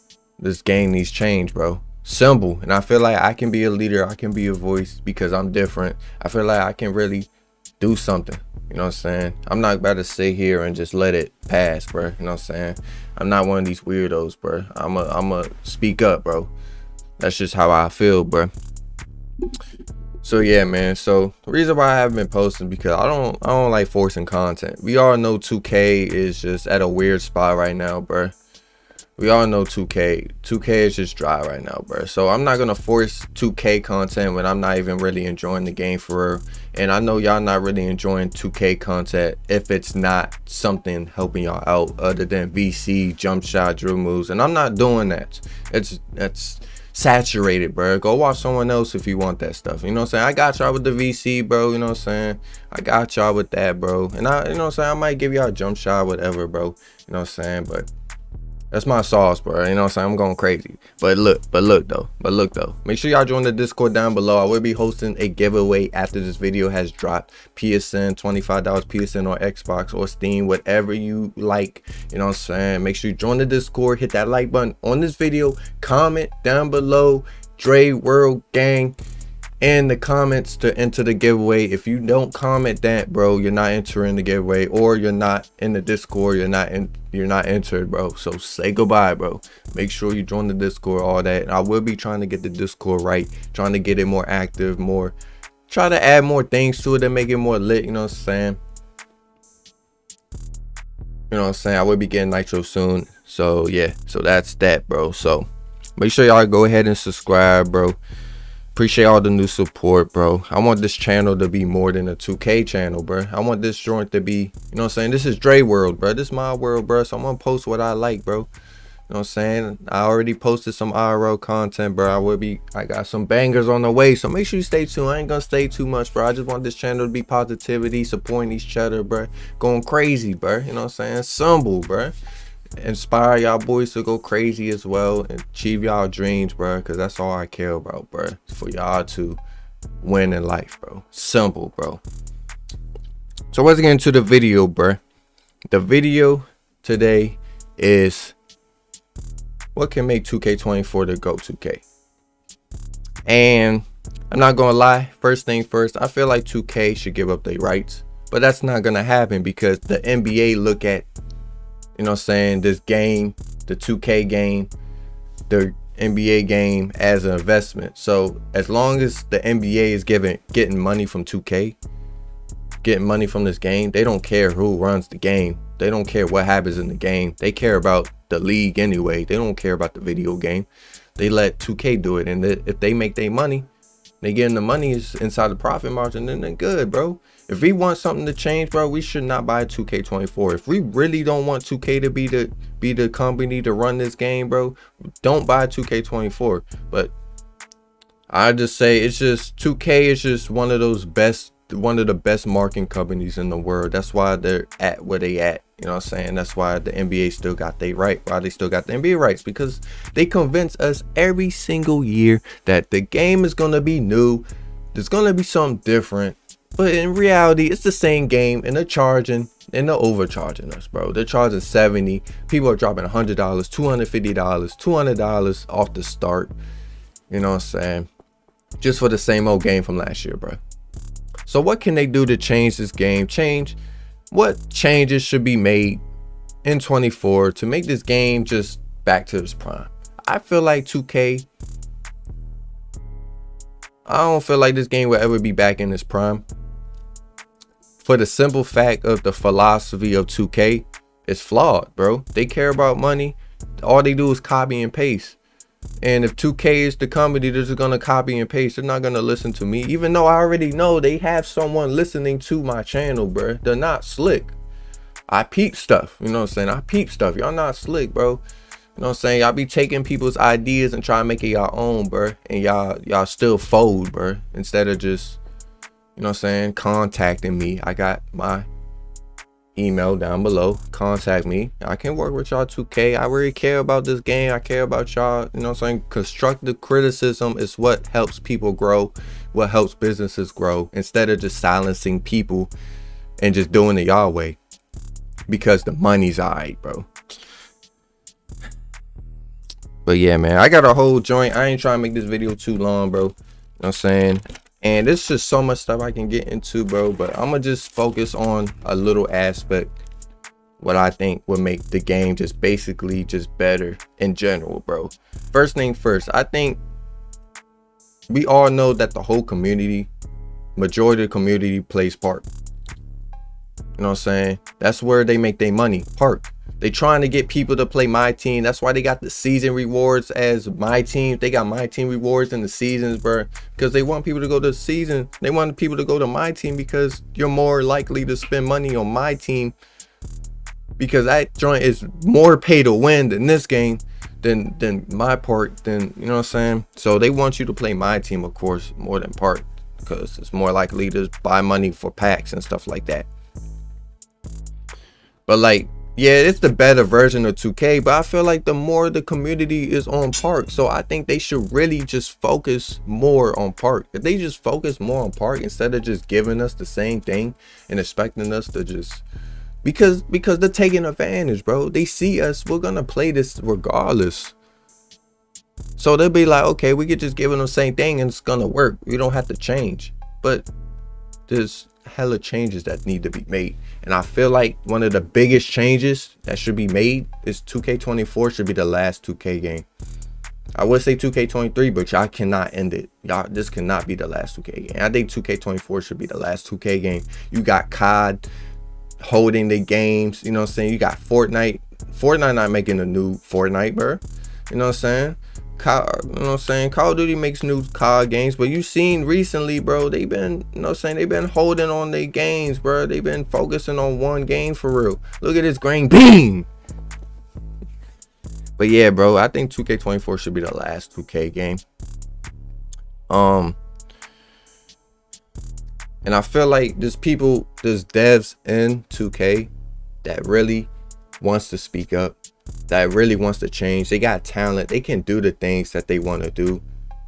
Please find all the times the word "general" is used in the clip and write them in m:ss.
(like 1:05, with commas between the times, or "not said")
5:14.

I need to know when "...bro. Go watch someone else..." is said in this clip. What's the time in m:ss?
0:47.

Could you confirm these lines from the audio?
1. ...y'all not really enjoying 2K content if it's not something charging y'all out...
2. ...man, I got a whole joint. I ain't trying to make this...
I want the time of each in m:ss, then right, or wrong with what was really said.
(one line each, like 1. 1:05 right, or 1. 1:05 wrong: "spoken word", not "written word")
1. 0:37 wrong: "helping", not "charging"
2. 5:00 right.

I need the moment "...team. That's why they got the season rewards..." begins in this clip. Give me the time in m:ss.
5:28.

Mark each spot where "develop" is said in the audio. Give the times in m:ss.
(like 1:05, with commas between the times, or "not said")
not said.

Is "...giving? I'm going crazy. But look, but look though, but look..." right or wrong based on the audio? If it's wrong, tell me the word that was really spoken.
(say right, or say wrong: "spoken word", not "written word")
wrong: "saying", not "giving".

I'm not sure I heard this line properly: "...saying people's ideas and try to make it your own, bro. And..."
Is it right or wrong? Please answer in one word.
wrong.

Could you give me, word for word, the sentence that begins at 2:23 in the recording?
So let's get into the video, bro.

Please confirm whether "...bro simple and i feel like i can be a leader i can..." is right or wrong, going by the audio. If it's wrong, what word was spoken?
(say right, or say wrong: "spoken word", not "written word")
right.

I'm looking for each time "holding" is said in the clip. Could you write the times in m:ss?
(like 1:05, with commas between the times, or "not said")
6:39, 6:51.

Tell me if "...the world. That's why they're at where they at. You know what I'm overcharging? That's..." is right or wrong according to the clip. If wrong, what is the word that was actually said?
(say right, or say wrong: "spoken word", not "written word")
wrong: "saying", not "overcharging".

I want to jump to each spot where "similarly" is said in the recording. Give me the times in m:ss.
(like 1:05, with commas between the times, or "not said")
not said.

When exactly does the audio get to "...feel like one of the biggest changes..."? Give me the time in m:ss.
6:24.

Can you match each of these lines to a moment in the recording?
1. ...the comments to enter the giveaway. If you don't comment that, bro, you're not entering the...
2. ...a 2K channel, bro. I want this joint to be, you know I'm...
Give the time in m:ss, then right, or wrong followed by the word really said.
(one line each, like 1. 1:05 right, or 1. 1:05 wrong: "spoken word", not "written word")
1. 1:19 right
2. 1:52 right.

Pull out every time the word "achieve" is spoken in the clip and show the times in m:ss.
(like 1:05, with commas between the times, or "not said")
2:15.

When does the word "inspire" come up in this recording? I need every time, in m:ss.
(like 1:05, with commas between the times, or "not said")
2:12.